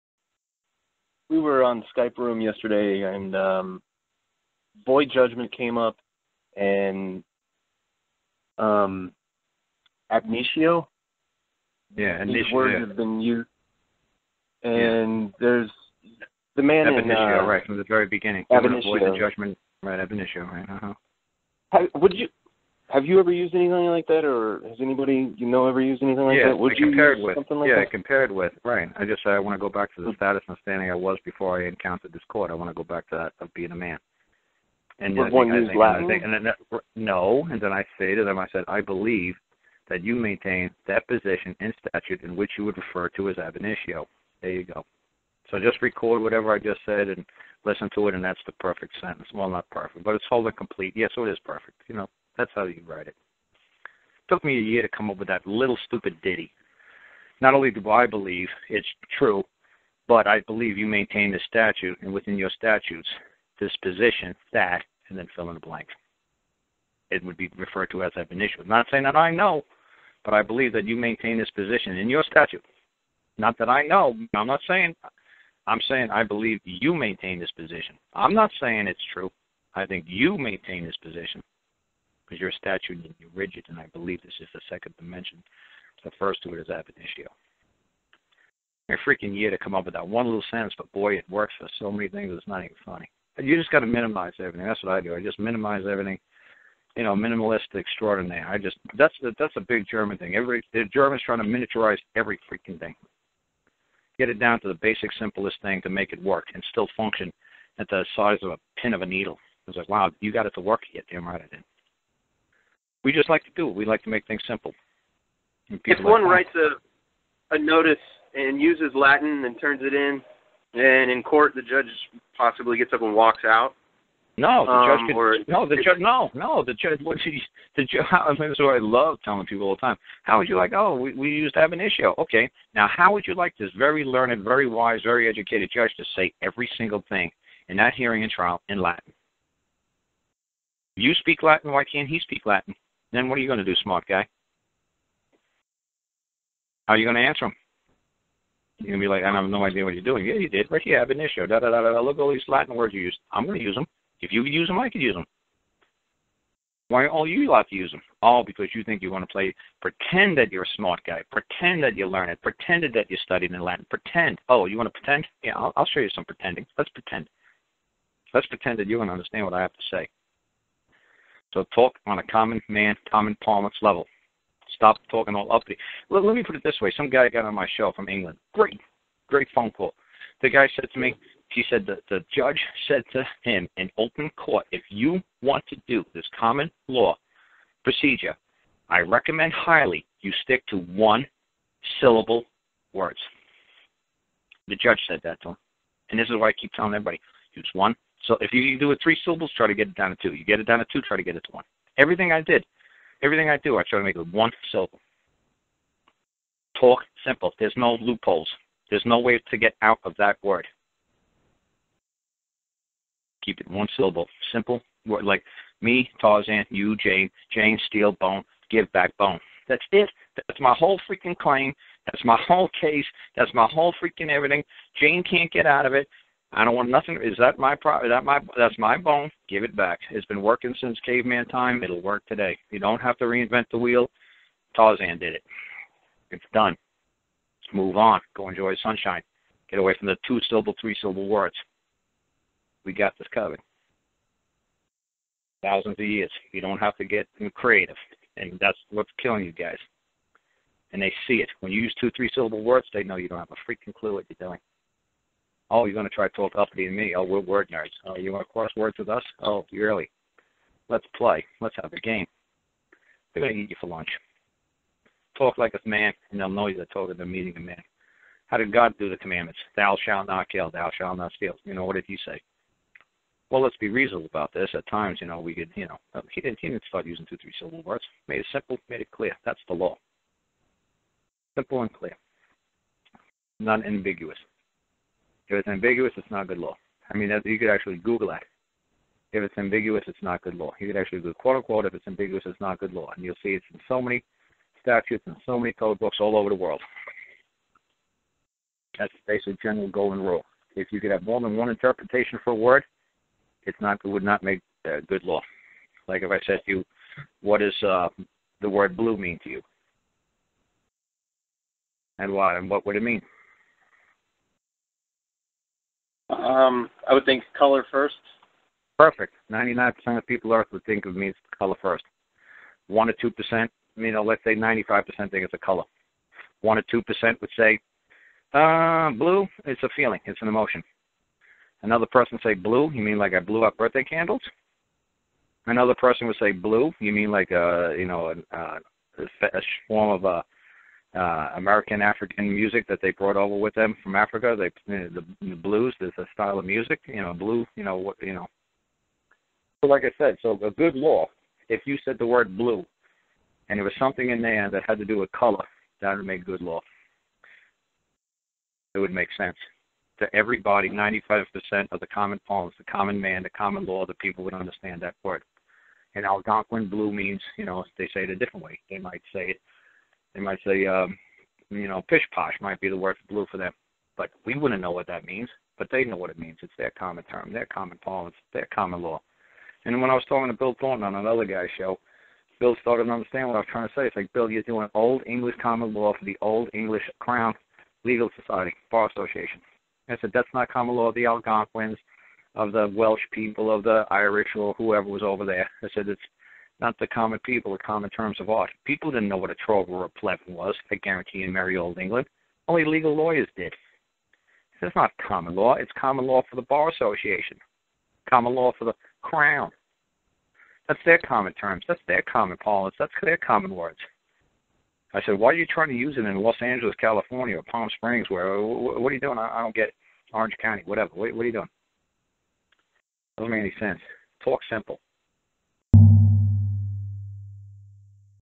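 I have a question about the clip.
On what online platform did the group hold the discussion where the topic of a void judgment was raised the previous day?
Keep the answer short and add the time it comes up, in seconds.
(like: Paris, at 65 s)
Skype, at 1 s.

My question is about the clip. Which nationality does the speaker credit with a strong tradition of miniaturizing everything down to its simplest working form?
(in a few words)
German.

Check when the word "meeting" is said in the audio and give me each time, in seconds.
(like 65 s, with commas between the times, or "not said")
267 s.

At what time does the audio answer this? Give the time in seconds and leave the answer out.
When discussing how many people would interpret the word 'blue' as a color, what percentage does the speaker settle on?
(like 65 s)
324 s.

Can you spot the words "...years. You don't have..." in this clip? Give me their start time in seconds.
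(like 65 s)
246 s.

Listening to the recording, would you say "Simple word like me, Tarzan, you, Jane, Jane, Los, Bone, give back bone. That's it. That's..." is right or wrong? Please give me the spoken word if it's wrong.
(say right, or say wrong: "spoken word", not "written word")
wrong: "Steel", not "Los".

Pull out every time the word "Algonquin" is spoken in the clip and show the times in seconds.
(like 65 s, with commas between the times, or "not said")
366 s, 391 s.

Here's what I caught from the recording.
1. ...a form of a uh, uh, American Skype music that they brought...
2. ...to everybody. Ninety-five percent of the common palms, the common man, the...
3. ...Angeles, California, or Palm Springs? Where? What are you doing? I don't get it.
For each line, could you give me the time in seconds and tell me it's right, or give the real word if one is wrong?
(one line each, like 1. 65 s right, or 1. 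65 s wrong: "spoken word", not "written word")
1. 339 s wrong: "African", not "Skype"
2. 360 s right
3. 416 s right.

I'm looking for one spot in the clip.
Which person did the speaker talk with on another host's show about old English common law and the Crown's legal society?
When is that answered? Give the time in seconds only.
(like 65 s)
380 s.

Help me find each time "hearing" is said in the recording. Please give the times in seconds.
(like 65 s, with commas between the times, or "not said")
137 s.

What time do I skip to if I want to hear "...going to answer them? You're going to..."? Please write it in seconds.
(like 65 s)
147 s.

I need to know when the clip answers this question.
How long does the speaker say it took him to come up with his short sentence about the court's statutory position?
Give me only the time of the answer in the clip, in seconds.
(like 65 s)
54 s.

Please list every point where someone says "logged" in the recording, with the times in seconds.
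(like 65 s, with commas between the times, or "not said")
not said.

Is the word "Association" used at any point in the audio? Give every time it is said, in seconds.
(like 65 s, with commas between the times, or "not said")
389 s, 406 s.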